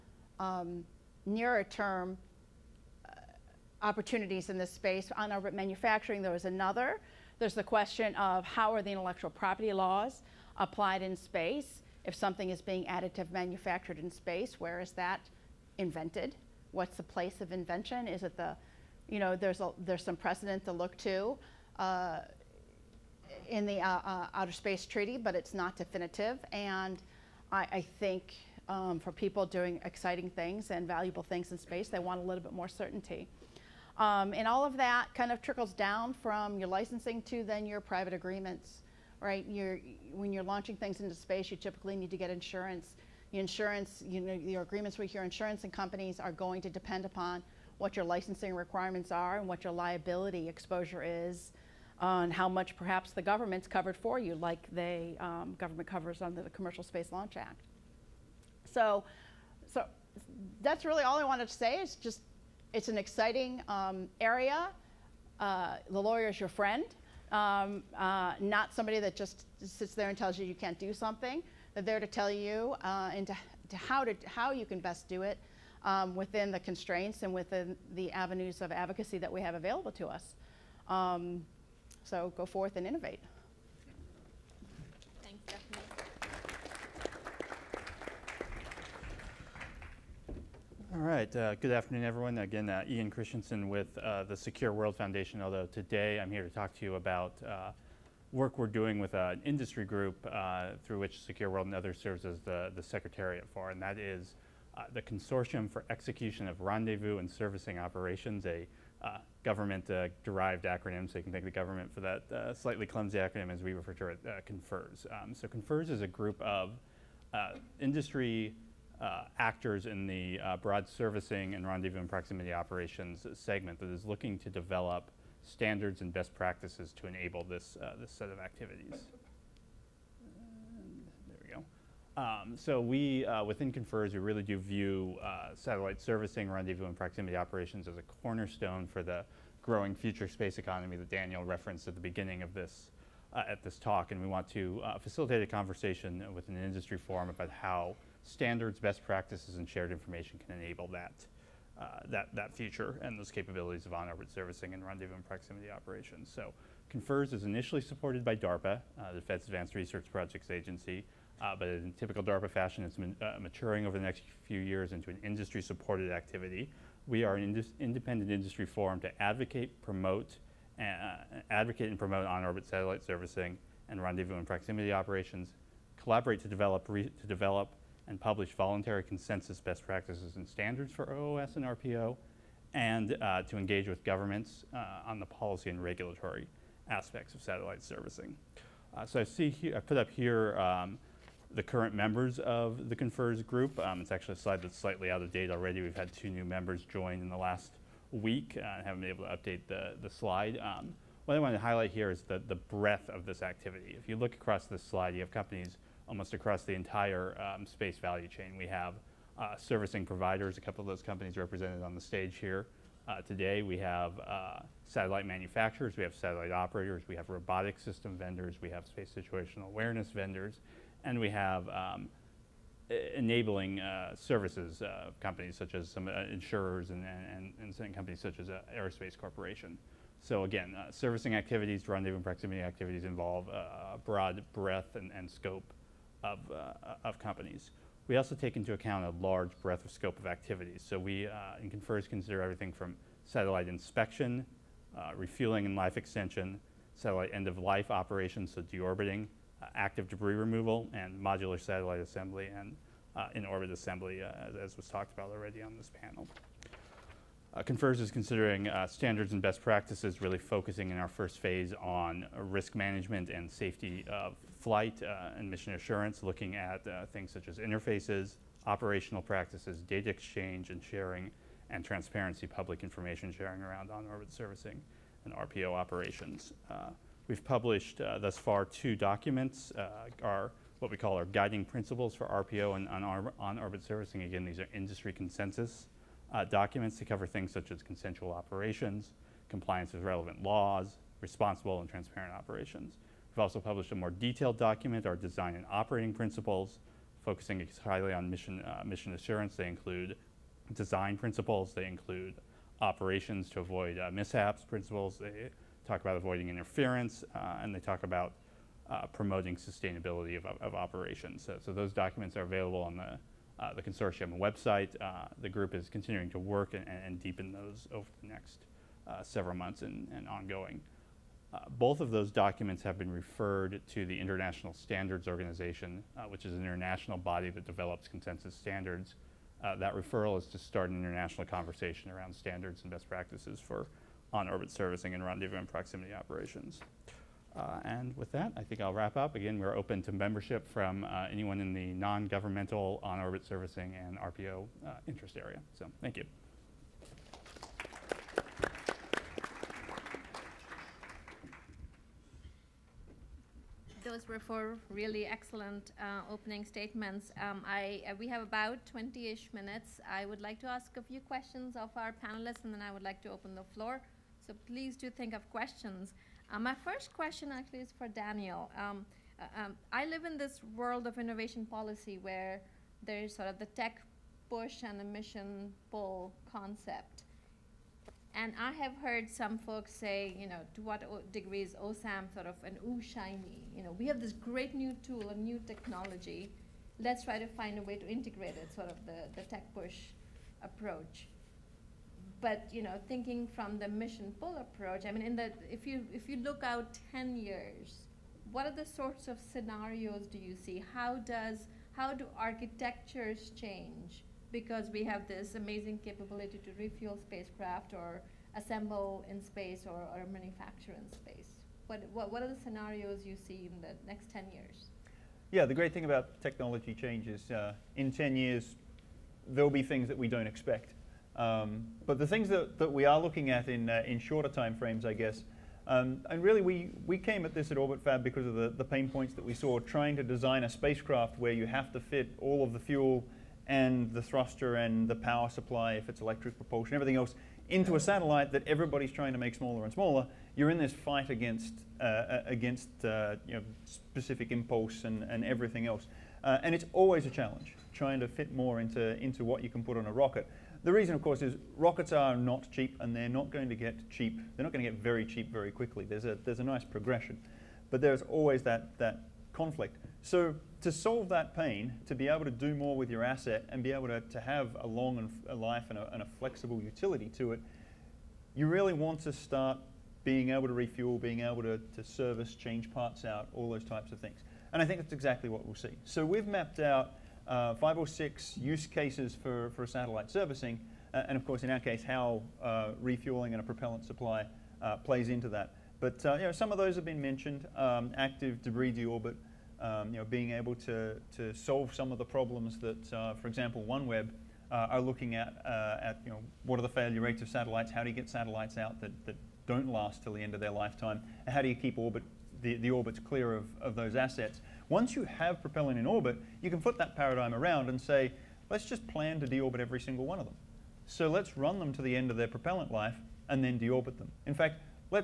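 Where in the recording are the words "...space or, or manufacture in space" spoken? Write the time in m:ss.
6:49.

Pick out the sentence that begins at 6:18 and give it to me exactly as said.
And I have heard some folks say, you know, to what degree is OSAM sort of an ooh shiny?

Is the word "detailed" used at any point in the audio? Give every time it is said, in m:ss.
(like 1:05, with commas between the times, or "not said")
4:54.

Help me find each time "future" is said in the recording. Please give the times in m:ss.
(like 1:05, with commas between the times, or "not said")
2:19, 2:32.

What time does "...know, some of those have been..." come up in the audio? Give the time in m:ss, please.
8:06.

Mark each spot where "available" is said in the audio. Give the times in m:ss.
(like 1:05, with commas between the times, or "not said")
1:19, 5:12.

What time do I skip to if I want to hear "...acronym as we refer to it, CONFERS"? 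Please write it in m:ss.
1:53.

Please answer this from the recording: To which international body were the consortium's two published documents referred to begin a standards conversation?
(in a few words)
International Standards Organization.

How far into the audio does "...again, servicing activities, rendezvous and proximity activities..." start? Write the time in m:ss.
3:50.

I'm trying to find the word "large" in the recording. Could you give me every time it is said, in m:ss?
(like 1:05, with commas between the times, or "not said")
3:59.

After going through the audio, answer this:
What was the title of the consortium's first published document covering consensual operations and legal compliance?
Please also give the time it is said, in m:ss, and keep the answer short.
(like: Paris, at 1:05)
guiding principles, at 4:41.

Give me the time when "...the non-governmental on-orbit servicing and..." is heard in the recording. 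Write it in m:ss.
5:41.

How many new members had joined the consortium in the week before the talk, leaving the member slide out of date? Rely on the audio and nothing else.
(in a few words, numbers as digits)
2.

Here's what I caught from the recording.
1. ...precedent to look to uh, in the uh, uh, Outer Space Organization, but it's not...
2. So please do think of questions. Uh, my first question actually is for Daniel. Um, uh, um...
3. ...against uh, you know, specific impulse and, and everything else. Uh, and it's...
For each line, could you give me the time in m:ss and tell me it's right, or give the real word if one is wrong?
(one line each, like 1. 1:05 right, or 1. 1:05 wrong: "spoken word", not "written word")
1. 0:20 wrong: "Treaty", not "Organization"
2. 6:04 right
3. 7:22 right.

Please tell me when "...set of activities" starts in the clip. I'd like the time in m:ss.
2:08.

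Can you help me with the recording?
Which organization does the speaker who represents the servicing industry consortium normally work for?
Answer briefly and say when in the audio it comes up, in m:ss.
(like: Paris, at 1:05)
Secure World Foundation, at 1:34.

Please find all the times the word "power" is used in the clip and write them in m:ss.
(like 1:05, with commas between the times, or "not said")
7:15.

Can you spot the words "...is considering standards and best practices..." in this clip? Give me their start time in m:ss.
4:18.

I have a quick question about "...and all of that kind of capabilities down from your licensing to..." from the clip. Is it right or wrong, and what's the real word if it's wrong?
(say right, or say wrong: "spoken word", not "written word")
wrong: "trickles", not "capabilities".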